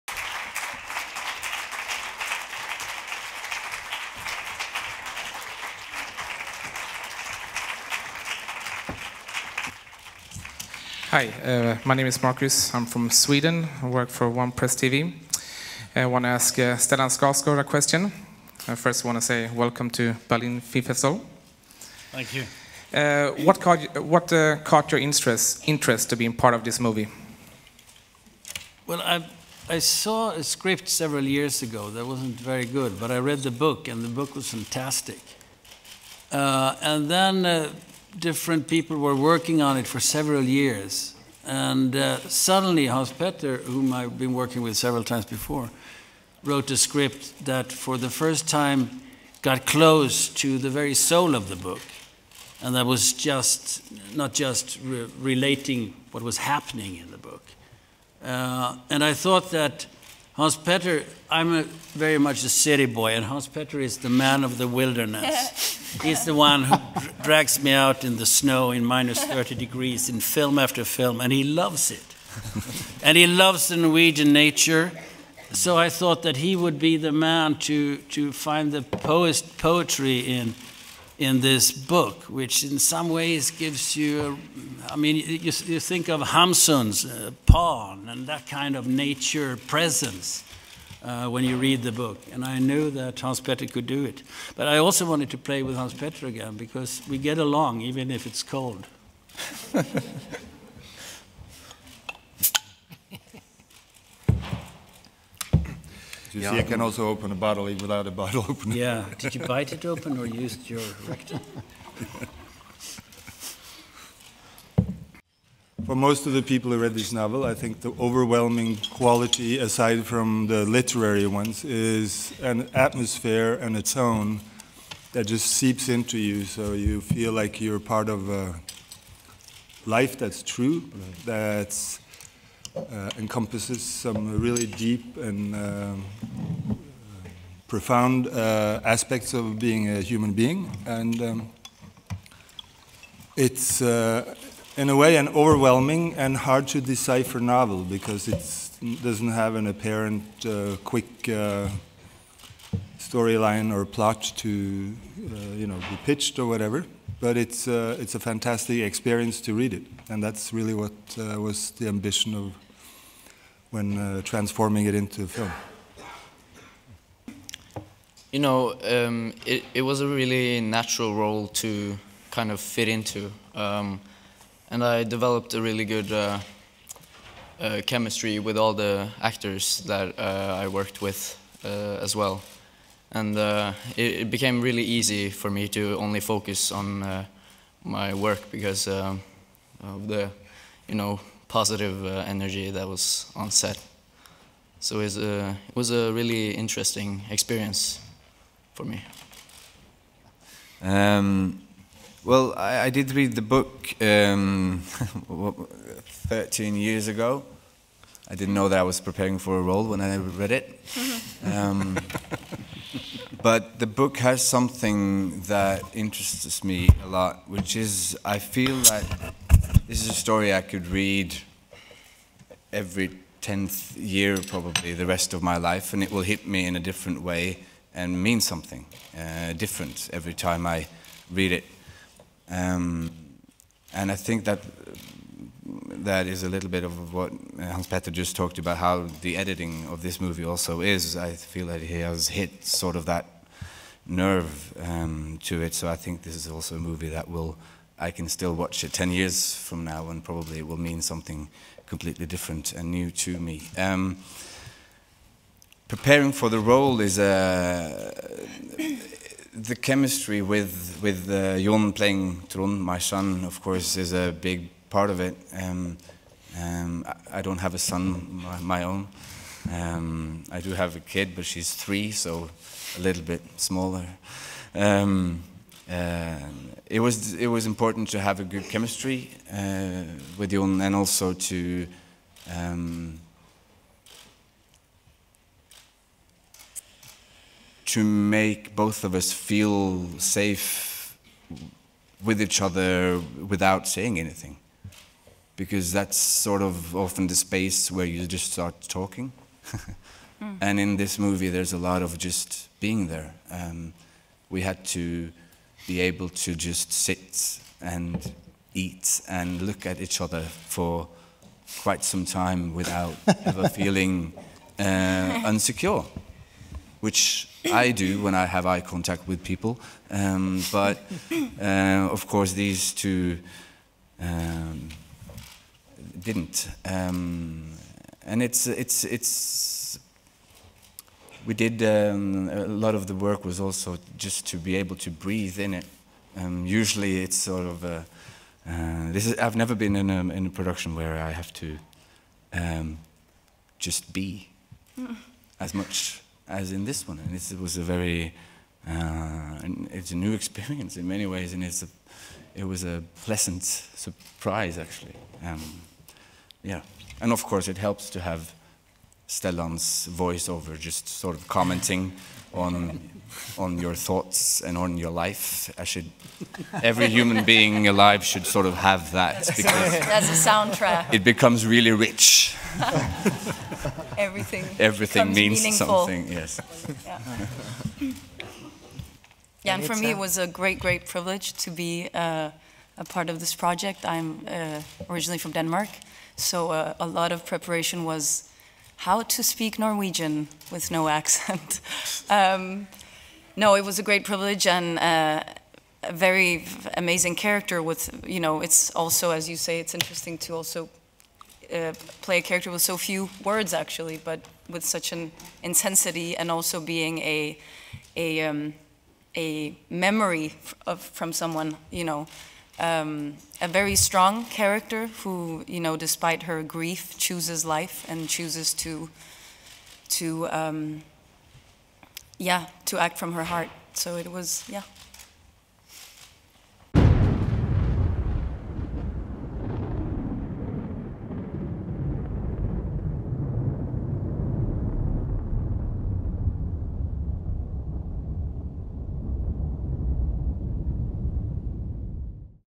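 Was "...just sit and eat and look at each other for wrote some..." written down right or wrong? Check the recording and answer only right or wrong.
wrong.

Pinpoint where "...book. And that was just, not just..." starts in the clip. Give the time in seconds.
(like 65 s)
51 s.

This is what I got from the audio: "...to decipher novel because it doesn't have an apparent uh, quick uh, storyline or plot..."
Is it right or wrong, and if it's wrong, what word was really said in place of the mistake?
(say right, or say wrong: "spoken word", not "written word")
right.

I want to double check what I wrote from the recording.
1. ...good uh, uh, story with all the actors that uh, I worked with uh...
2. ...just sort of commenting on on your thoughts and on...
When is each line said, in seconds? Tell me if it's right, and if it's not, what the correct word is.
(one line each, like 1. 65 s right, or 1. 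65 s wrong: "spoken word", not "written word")
1. 175 s wrong: "chemistry", not "story"
2. 360 s right.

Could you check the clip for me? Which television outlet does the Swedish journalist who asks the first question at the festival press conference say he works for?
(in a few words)
One Press TV.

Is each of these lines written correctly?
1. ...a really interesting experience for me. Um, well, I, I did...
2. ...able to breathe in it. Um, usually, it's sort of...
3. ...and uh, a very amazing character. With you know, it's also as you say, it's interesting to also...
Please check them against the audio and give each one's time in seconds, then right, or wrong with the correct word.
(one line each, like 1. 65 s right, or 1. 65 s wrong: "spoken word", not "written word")
1. 195 s right
2. 334 s right
3. 394 s right.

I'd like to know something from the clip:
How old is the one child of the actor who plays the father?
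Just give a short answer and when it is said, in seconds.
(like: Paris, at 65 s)
3, at 271 s.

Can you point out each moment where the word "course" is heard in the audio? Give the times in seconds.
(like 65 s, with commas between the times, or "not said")
263 s, 322 s, 357 s.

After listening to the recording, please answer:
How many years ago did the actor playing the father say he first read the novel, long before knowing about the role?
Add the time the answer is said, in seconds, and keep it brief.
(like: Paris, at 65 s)
13, at 206 s.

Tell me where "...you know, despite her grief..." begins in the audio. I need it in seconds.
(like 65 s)
415 s.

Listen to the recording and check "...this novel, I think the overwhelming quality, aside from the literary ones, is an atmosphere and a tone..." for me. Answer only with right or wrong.
right.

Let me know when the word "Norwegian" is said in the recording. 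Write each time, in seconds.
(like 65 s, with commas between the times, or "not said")
73 s, 389 s.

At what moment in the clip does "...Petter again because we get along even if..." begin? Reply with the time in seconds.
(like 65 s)
95 s.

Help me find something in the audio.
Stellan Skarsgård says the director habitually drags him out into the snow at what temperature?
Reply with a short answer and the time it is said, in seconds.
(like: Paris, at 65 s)
minus 30 degrees, at 68 s.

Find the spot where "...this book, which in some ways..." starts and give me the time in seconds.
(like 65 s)
81 s.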